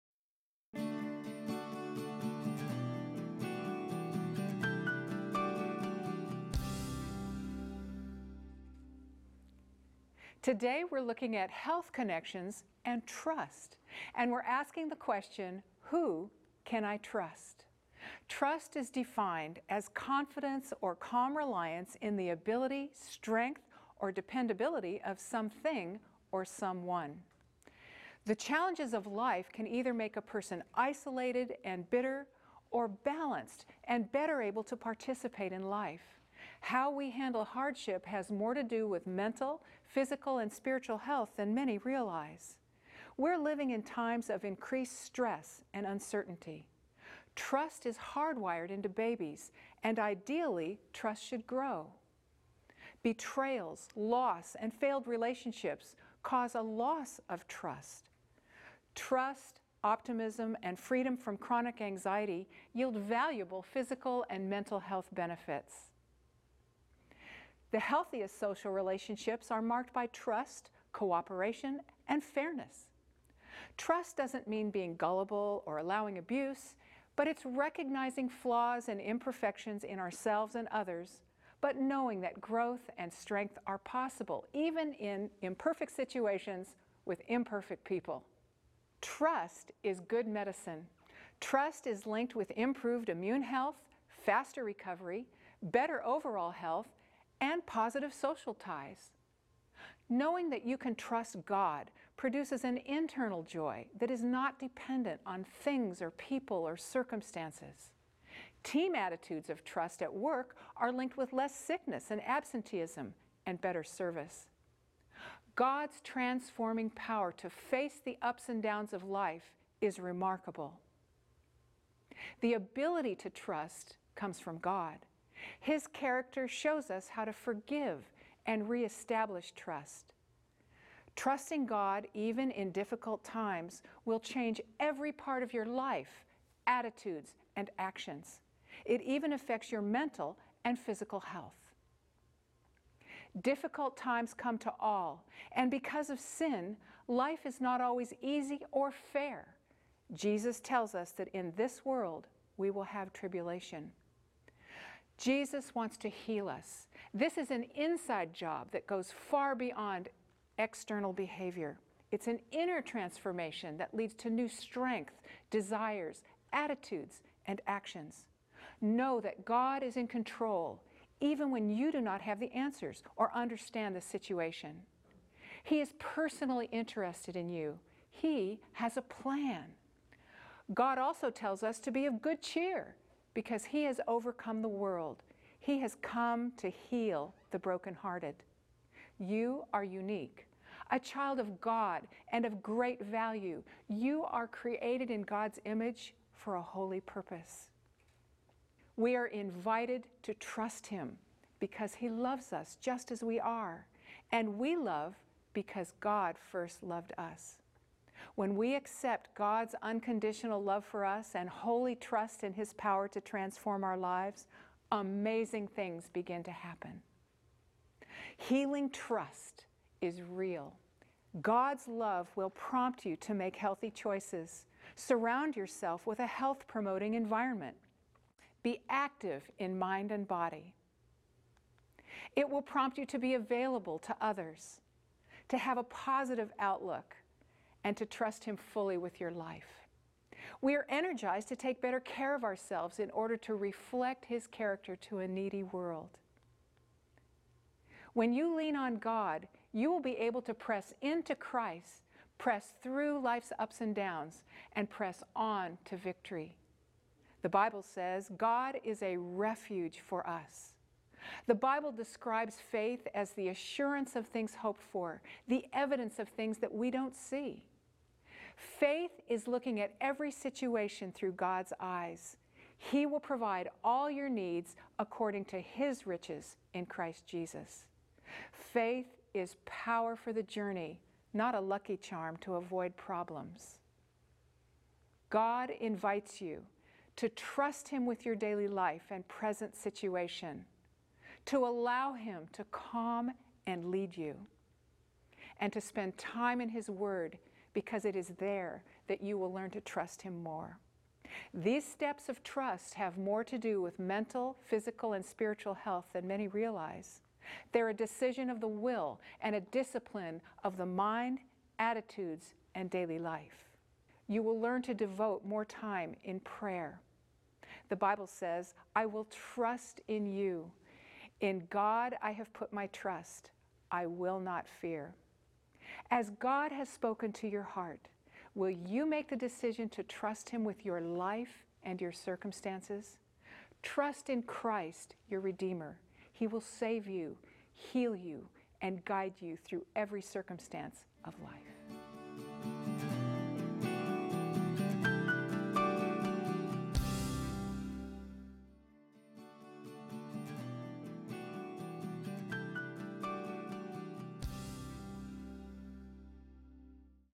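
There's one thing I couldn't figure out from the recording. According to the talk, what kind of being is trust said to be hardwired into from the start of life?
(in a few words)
Babies.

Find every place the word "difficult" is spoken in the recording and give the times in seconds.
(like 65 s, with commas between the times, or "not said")
132 s, 143 s.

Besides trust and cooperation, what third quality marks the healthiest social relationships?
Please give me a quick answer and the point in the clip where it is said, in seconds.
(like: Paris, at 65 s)
Fairness, at 72 s.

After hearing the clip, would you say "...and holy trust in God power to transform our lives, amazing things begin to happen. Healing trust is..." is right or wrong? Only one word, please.
wrong.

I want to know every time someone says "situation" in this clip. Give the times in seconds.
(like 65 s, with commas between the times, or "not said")
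85 s, 174 s, 270 s, 289 s.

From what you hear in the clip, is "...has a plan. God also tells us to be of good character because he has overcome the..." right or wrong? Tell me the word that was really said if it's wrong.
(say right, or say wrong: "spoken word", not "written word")
wrong: "cheer", not "character".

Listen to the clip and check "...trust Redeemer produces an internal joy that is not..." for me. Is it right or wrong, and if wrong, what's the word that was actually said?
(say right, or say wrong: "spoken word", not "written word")
wrong: "God", not "Redeemer".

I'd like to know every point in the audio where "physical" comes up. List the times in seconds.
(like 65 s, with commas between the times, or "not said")
39 s, 63 s, 140 s, 304 s.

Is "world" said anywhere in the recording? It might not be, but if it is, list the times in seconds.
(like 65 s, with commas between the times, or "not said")
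151 s, 184 s, 245 s.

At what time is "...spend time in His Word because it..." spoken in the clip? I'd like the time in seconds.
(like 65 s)
295 s.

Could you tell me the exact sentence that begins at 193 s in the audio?
You are created in God's image for a holy purpose.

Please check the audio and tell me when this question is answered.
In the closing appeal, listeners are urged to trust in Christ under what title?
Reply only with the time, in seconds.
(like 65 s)
335 s.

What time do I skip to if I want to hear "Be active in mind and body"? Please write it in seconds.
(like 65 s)
228 s.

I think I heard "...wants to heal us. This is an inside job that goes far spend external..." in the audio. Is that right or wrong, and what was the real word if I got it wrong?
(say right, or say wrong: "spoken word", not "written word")
wrong: "beyond", not "spend".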